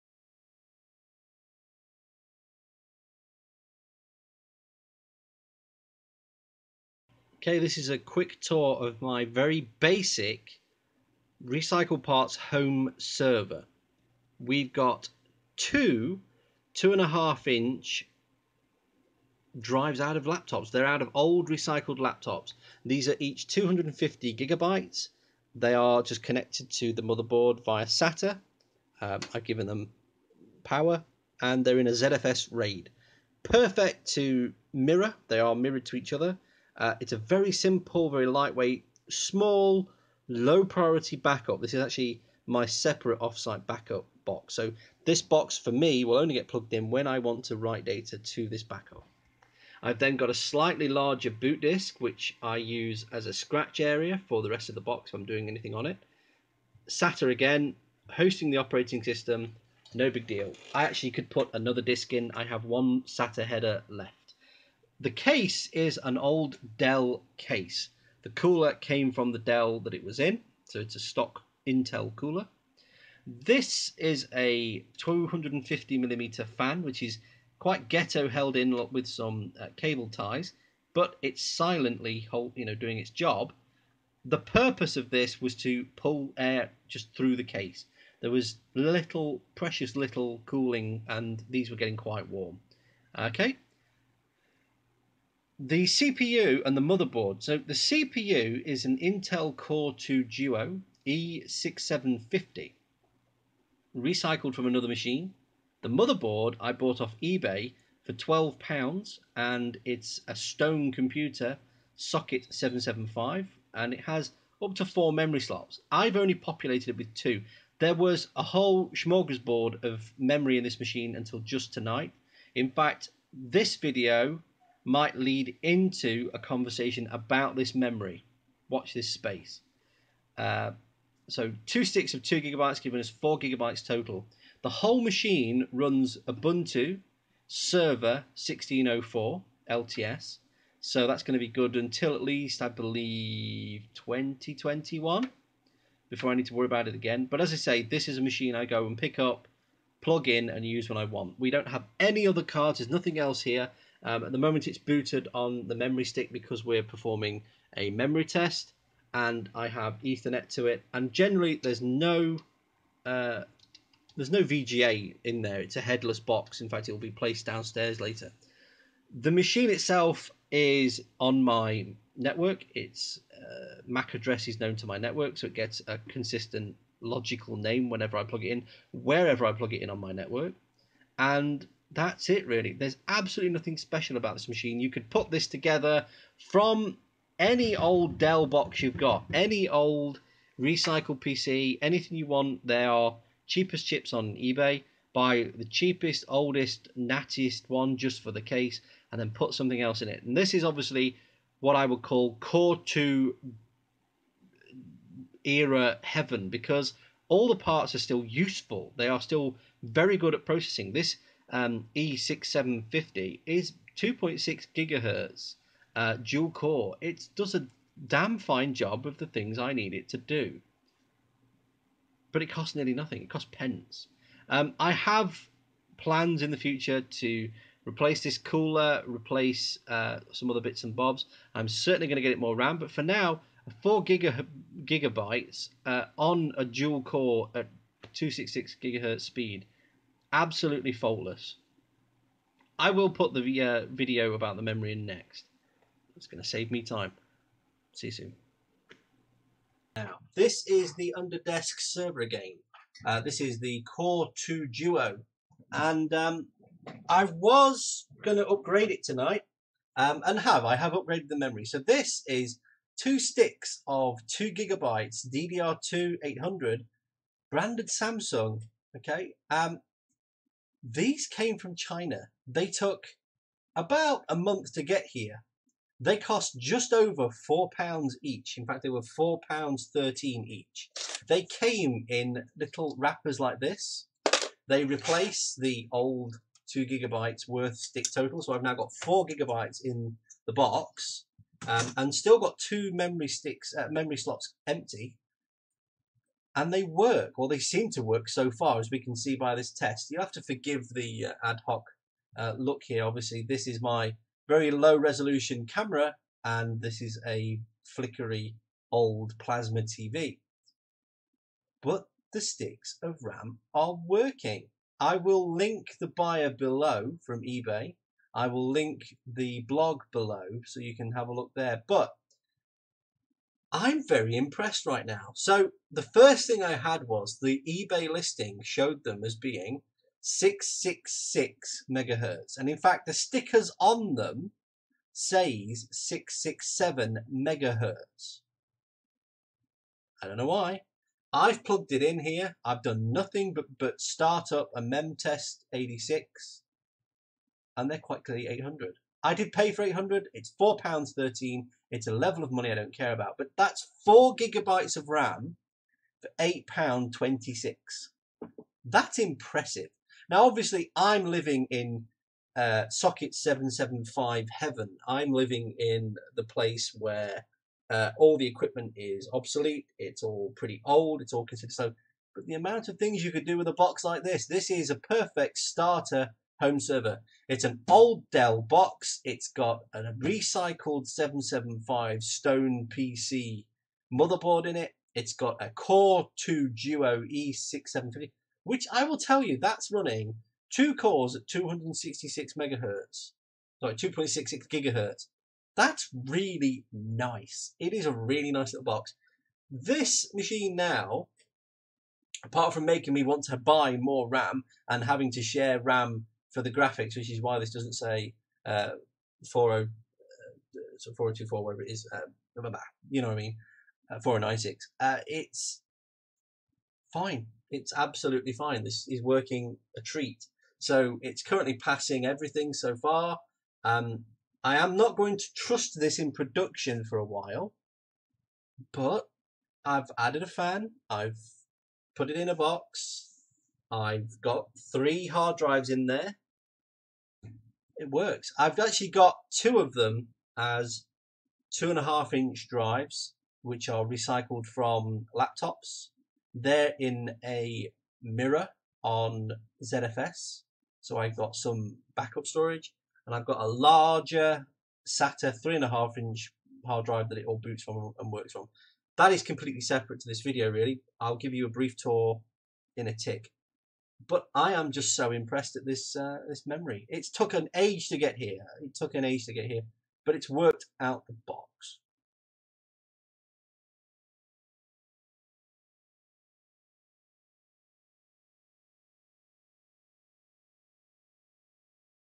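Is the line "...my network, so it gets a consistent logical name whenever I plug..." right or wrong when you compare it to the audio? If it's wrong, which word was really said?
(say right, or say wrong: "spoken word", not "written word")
right.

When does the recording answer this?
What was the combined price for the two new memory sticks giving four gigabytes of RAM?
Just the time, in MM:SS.
05:56.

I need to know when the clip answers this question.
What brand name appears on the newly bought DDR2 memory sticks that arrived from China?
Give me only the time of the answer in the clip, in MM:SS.
04:27.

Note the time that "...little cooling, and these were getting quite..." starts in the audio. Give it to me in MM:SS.
01:29.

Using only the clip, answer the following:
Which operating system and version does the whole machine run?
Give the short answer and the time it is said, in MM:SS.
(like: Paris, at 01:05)
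Ubuntu Server 16.04 LTS, at 02:16.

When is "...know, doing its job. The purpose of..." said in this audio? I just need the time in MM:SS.
01:22.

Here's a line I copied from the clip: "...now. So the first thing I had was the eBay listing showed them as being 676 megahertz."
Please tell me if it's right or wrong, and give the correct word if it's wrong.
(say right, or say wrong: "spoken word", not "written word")
wrong: "666", not "676".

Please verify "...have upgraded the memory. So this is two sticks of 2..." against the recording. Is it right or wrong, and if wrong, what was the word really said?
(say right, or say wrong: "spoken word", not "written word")
right.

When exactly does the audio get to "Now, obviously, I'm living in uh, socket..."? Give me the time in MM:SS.
06:00.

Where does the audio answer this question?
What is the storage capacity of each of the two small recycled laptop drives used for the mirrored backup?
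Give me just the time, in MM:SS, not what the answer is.
00:23.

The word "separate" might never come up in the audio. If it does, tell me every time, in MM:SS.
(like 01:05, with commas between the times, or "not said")
00:42, 07:39.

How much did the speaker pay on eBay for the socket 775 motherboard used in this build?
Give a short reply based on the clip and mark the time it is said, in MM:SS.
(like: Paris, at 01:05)
£12, at 01:48.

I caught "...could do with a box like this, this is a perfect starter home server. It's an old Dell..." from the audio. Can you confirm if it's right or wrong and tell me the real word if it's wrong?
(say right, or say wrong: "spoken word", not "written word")
right.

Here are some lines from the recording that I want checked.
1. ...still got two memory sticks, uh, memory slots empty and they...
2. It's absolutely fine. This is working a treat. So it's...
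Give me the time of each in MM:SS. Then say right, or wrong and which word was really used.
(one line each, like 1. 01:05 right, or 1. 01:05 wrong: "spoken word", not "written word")
1. 04:52 right
2. 06:57 right.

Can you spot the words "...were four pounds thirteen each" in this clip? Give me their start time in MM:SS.
04:38.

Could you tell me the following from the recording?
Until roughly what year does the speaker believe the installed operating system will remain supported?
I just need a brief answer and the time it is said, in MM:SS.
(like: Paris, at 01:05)
2021, at 02:23.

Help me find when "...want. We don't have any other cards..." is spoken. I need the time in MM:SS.
02:31.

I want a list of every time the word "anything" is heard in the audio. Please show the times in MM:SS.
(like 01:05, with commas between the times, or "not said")
00:55, 03:11.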